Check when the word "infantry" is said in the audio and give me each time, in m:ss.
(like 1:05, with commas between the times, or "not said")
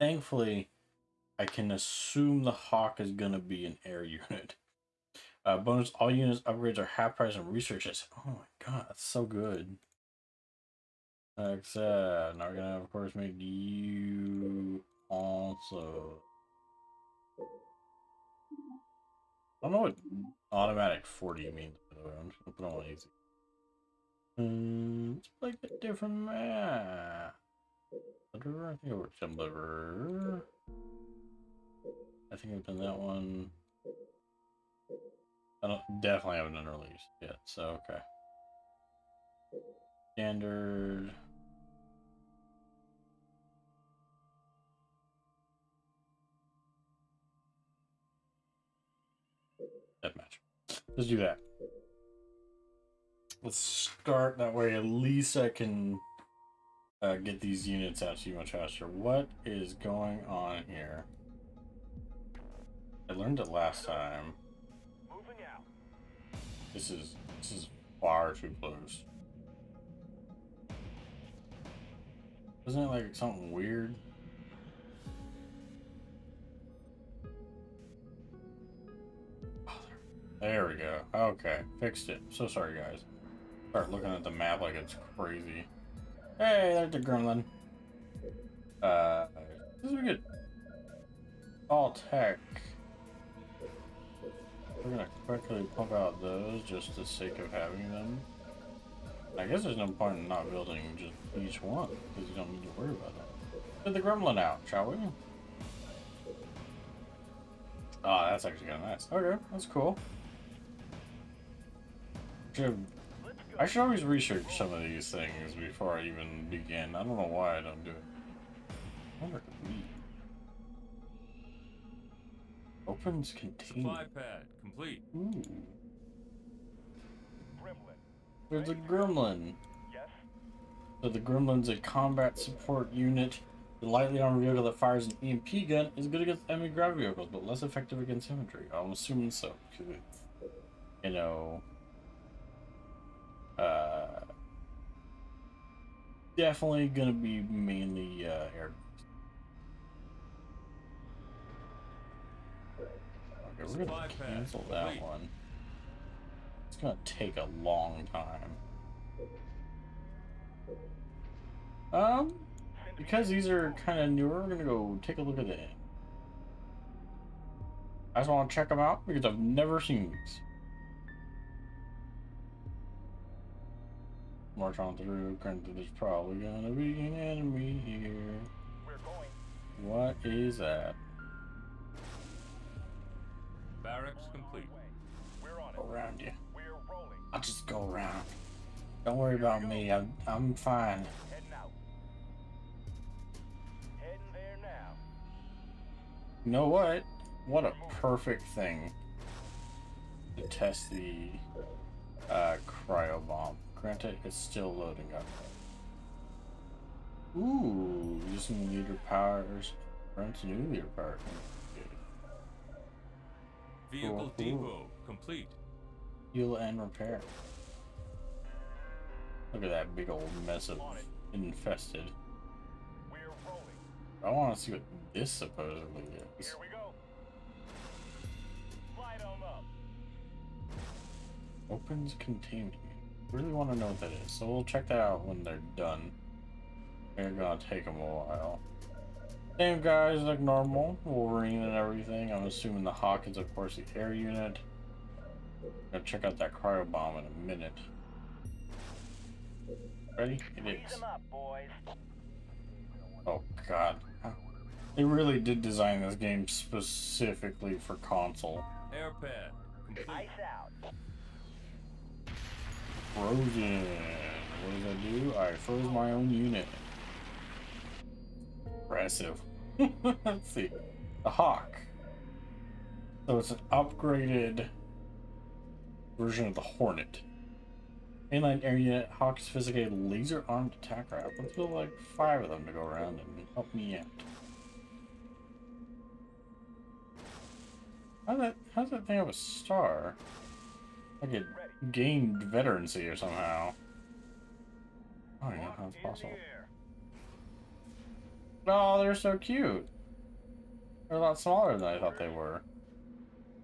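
2:18.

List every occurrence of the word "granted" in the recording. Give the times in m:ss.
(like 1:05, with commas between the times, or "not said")
2:55, 3:23.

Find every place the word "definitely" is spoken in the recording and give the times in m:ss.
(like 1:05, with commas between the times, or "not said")
0:36, 2:26.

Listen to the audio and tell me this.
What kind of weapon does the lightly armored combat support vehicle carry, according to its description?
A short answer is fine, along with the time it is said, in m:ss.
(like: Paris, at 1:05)
EMP gun, at 2:15.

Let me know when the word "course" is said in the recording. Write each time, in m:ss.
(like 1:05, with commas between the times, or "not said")
0:12, 4:03.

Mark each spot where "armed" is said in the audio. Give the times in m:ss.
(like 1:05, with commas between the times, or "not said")
4:40.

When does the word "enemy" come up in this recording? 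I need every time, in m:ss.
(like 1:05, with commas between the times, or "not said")
2:16, 2:57.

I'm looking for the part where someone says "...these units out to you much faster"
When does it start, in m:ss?
0:57.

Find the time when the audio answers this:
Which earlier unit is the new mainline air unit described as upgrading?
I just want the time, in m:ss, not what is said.
4:36.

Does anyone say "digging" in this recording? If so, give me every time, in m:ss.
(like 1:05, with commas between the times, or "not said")
not said.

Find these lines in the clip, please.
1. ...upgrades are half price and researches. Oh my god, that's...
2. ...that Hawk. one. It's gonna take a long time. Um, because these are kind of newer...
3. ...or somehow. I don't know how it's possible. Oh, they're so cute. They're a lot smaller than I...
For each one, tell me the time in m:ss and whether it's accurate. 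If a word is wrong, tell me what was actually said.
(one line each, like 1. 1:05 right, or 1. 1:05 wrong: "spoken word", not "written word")
1. 0:06 right
2. 2:34 wrong: "Wait", not "Hawk"
3. 4:53 right.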